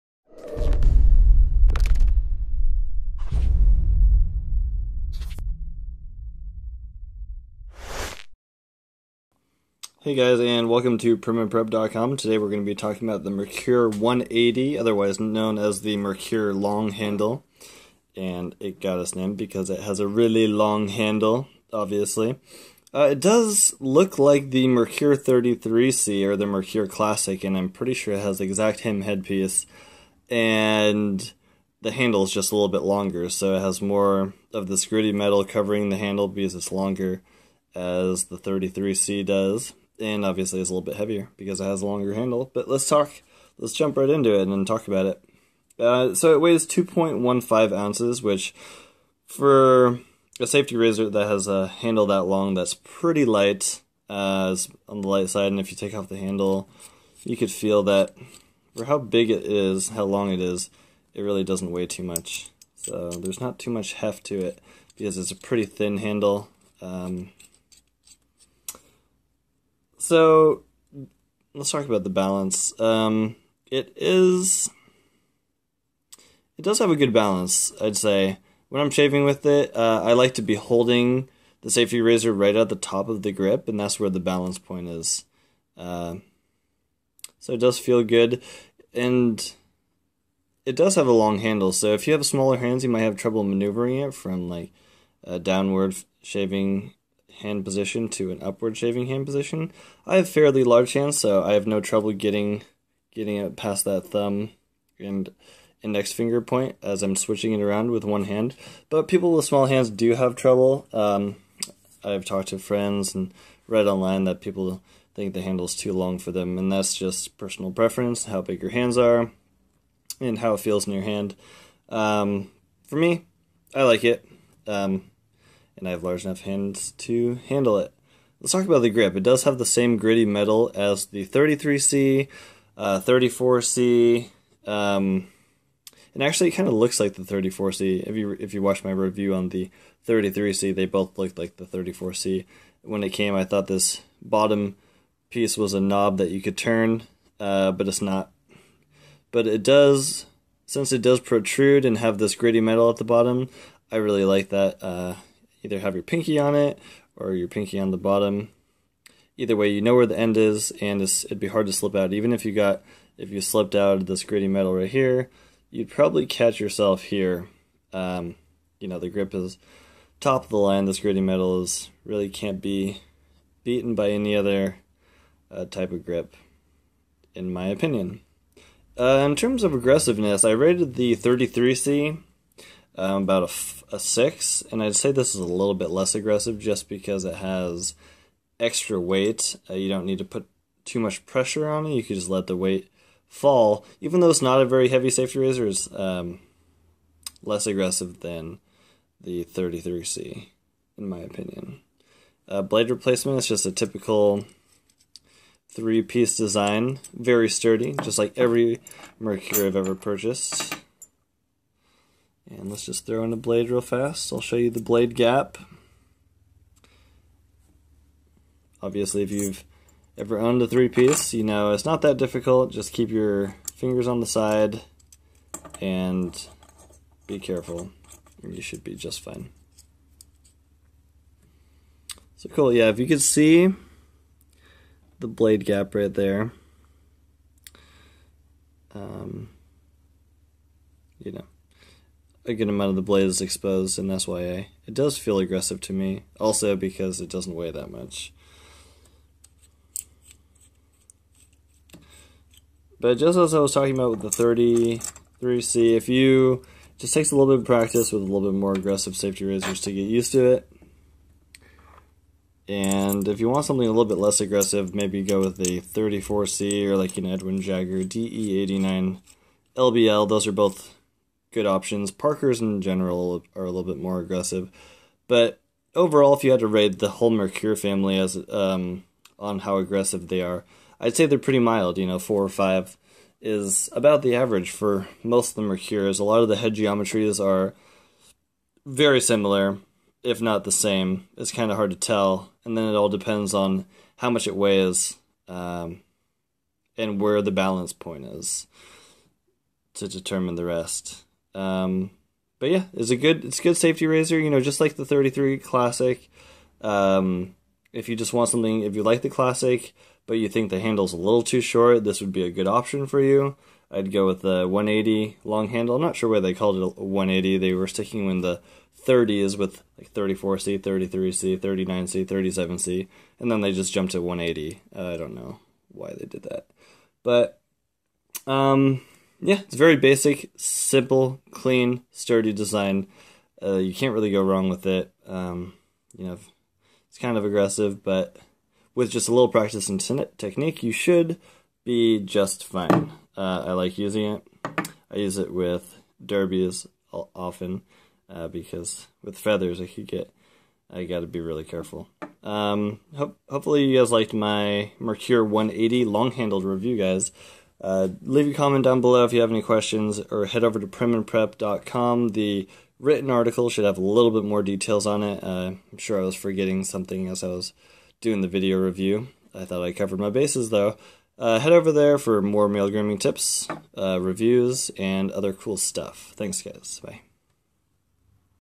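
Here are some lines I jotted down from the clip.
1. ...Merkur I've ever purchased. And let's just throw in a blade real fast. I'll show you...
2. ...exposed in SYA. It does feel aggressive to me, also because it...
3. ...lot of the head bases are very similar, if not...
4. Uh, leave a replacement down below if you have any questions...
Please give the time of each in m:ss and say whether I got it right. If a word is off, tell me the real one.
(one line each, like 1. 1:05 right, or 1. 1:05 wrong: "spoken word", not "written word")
1. 3:29 right
2. 4:03 right
3. 4:46 wrong: "geometries", not "bases"
4. 5:57 wrong: "comment", not "replacement".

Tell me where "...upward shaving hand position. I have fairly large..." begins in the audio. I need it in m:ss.
1:38.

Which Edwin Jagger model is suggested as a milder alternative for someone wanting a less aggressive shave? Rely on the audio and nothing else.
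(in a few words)
DE89 LBL.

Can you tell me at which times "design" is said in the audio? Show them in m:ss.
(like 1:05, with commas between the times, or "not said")
3:26, 5:32.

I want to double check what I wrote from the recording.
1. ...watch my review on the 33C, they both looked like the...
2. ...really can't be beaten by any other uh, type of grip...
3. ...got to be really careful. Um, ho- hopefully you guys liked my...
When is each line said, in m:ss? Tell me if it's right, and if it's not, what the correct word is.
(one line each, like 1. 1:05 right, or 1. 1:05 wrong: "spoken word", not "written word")
1. 2:18 right
2. 2:52 right
3. 5:51 right.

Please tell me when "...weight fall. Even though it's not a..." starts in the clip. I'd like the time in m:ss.
3:12.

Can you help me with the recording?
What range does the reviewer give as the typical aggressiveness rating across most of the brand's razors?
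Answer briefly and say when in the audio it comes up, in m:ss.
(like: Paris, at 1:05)
4 or 5, at 4:42.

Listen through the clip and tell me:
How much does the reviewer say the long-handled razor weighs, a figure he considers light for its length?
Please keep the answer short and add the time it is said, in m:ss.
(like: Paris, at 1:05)
2.15 ounces, at 0:46.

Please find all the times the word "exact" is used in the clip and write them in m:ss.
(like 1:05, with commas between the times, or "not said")
0:28.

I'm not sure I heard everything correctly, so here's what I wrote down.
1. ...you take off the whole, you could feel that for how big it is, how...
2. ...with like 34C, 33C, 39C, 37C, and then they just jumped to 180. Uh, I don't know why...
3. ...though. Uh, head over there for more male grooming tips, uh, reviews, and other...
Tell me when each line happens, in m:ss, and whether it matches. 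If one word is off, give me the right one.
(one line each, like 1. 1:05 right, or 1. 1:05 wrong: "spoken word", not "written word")
1. 0:55 wrong: "handle", not "whole"
2. 5:19 right
3. 6:10 right.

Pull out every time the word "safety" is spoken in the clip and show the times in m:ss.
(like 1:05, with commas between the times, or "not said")
0:50, 1:21, 3:15, 4:19, 5:03.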